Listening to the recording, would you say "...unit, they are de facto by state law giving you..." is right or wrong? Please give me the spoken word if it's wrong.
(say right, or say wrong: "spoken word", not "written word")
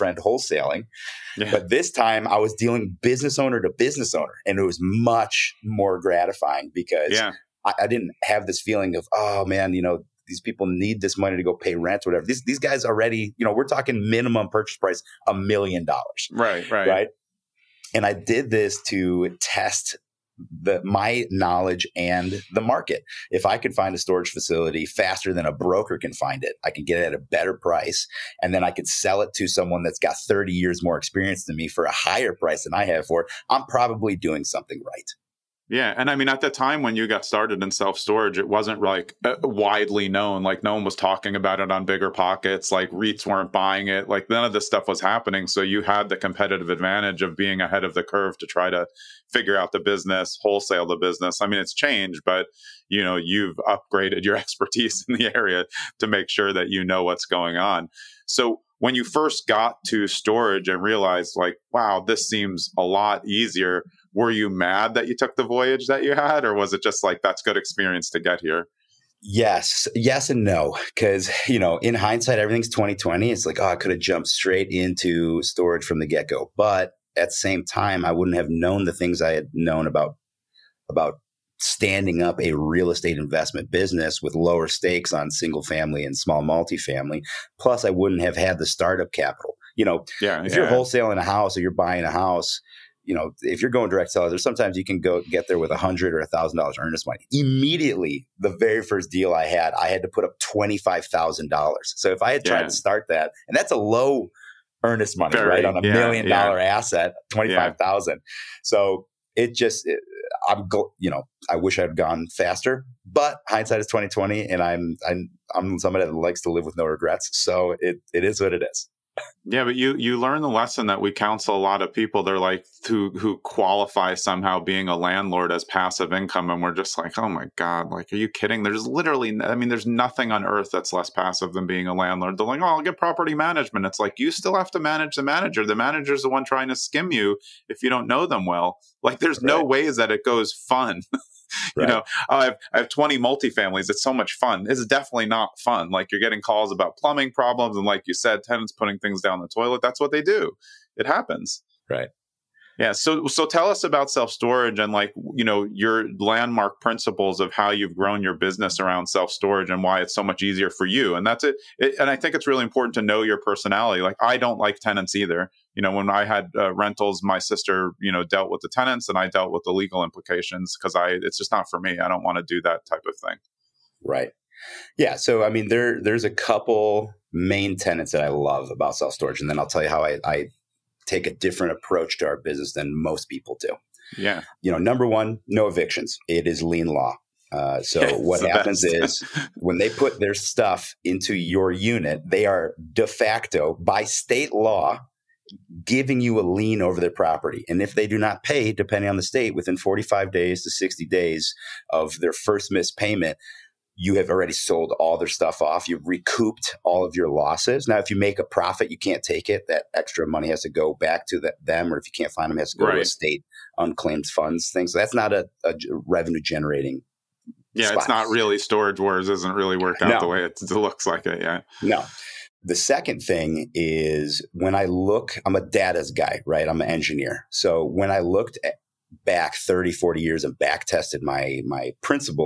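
right.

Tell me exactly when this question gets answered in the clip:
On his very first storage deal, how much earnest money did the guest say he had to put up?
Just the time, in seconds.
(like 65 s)
100 s.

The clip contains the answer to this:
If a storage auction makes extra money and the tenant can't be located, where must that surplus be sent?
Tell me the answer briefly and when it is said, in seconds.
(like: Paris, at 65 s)
State unclaimed funds, at 213 s.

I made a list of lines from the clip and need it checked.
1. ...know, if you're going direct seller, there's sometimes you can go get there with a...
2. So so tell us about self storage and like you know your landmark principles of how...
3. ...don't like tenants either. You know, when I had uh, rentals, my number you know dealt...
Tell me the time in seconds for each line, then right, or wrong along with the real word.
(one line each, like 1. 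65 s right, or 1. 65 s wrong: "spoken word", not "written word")
1. 93 s right
2. 152 s right
3. 164 s wrong: "sister", not "number".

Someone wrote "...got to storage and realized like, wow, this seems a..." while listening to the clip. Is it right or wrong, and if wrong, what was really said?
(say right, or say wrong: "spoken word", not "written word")
right.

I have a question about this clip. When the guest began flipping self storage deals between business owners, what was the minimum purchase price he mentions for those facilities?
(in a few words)
$1,000,000.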